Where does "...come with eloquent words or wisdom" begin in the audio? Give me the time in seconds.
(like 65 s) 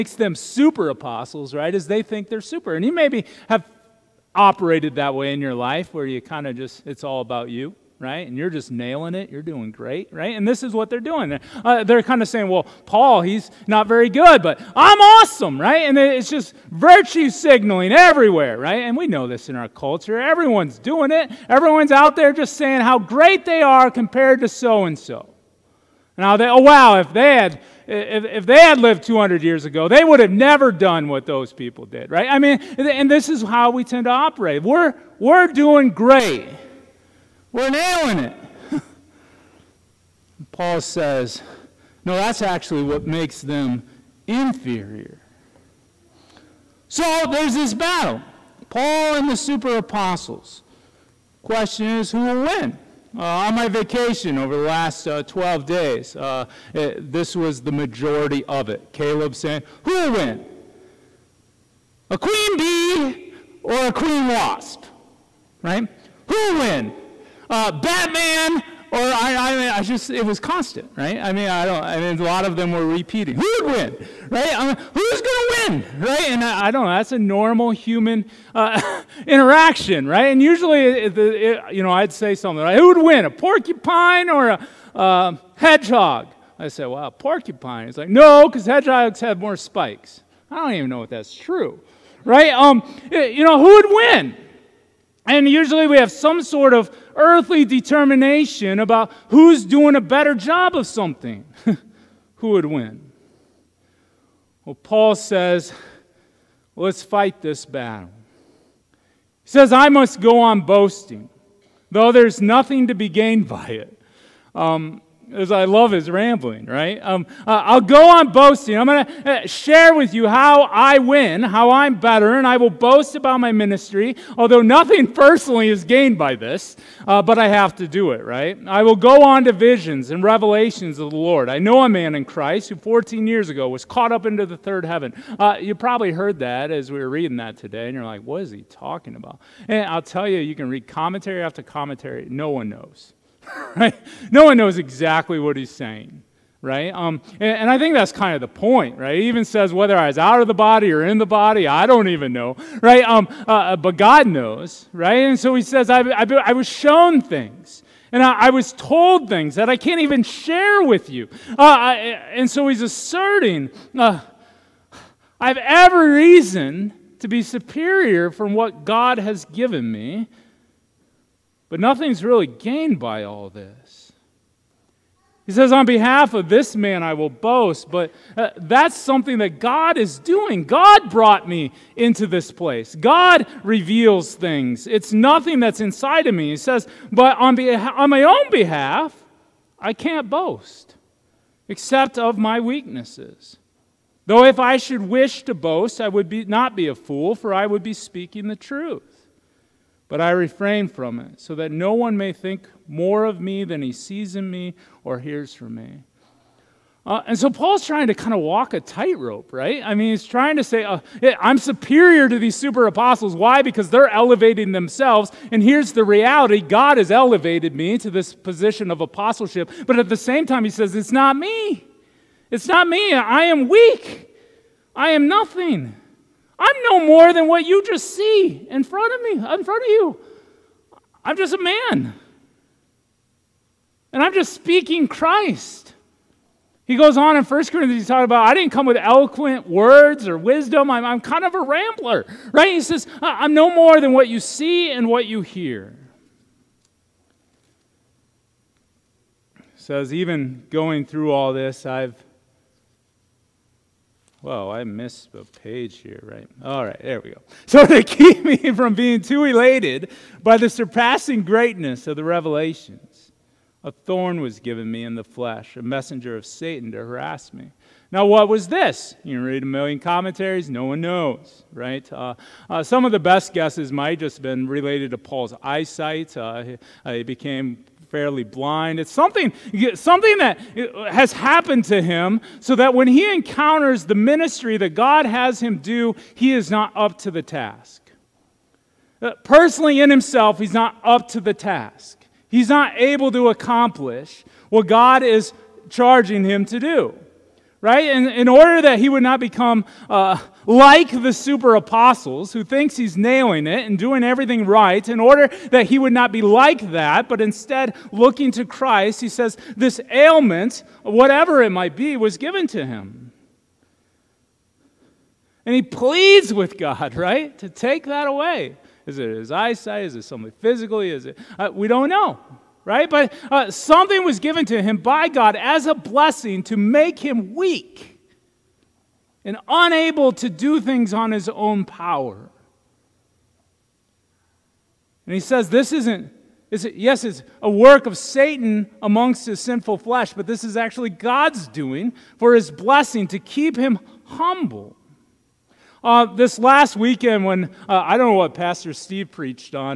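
238 s.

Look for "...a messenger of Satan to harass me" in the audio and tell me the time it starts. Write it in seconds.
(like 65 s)
265 s.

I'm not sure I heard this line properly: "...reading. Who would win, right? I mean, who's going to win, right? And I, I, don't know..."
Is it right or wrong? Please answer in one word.
wrong.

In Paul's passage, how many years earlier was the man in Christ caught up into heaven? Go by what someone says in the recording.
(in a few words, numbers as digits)
14.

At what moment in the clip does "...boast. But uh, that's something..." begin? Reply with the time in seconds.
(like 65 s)
177 s.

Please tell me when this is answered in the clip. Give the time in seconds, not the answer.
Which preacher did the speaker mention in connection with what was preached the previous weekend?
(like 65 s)
348 s.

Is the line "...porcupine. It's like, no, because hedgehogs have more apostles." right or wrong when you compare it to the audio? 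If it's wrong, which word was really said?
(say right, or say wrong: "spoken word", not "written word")
wrong: "spikes", not "apostles".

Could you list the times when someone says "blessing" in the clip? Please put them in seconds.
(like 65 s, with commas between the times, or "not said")
325 s, 342 s.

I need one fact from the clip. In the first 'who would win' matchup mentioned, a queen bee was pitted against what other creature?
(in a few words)
Queen wasp.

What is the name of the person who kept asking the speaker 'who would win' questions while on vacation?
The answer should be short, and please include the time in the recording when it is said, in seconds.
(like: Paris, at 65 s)
Caleb, at 58 s.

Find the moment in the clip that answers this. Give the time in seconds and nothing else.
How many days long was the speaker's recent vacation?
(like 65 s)
55 s.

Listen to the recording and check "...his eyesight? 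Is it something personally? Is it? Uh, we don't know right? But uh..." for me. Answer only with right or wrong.
wrong.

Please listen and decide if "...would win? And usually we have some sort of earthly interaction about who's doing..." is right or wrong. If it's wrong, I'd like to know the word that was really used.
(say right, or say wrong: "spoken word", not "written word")
wrong: "determination", not "interaction".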